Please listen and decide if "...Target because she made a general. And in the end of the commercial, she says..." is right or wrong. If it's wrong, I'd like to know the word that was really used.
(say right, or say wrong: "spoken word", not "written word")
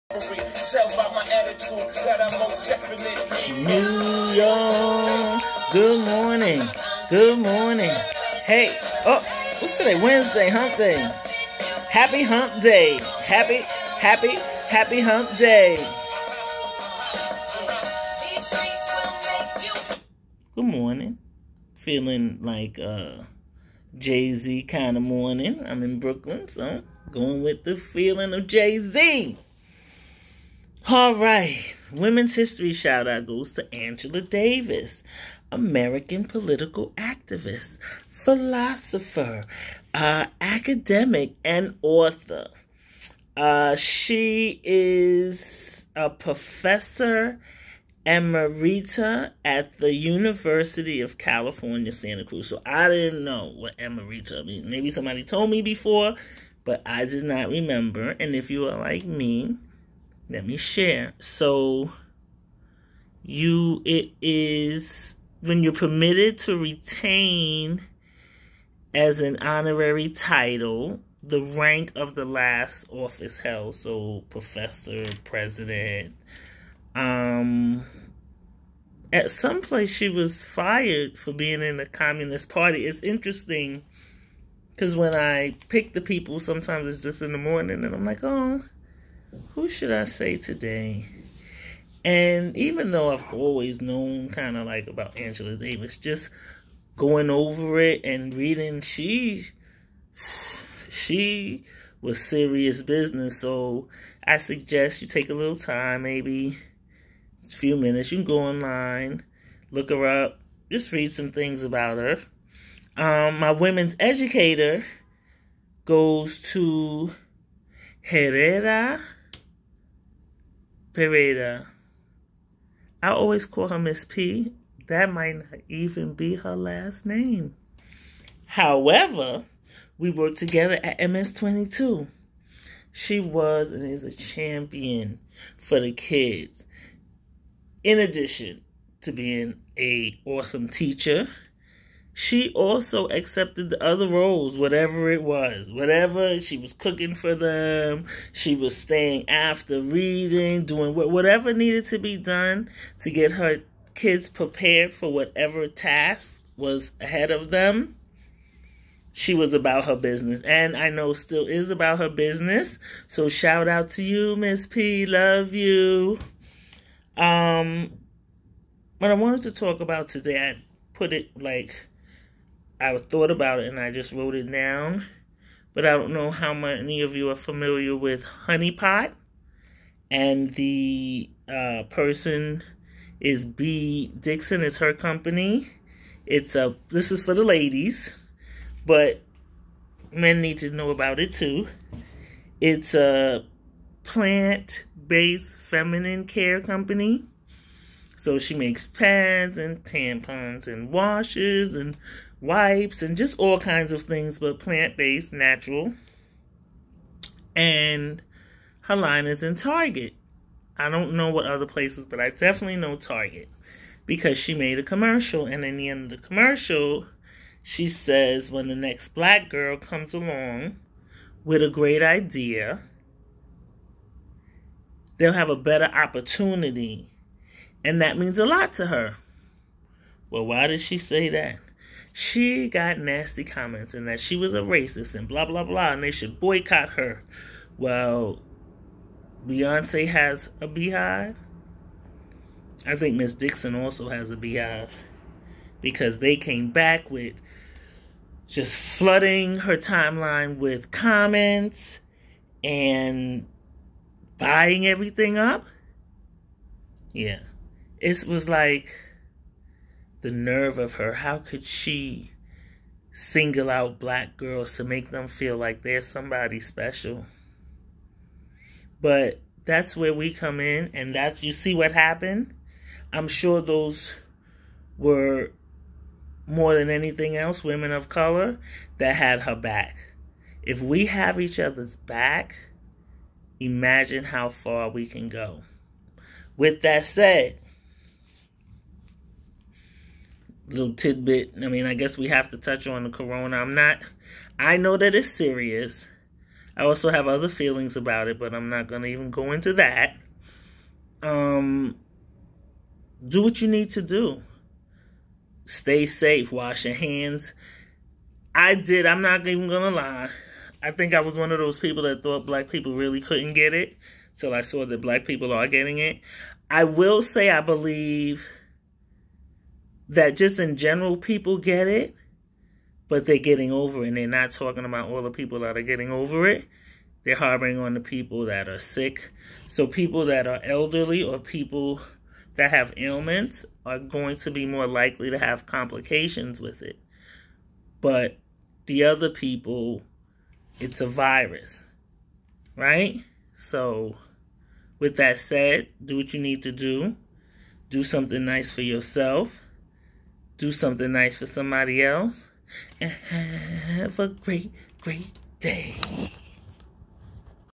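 wrong: "commercial", not "general".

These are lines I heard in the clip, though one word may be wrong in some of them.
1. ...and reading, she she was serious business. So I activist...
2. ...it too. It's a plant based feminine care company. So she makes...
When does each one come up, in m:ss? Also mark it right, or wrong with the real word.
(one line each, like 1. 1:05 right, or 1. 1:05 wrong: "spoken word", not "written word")
1. 1:38 wrong: "suggest", not "activist"
2. 3:11 right.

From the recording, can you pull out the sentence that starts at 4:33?
I'm sure those were more than anything else women of color that had her back.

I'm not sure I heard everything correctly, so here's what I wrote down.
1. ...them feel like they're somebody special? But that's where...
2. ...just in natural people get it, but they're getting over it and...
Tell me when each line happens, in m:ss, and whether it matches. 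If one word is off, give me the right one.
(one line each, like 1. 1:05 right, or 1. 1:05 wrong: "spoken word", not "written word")
1. 4:25 right
2. 5:20 wrong: "general", not "natural".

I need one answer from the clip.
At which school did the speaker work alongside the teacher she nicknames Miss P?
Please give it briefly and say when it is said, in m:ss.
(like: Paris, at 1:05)
MS22, at 2:10.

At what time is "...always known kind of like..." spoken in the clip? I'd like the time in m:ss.
1:33.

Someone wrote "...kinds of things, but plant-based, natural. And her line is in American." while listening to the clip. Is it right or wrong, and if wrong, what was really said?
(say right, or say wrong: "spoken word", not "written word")
wrong: "Target", not "American".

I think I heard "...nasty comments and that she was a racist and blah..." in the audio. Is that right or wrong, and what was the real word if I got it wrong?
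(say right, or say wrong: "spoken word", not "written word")
right.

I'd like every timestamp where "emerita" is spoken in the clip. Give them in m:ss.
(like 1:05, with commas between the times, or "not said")
0:48, 0:53.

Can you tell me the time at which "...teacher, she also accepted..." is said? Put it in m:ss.
2:20.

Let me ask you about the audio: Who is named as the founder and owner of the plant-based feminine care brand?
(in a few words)
Bea Dixon.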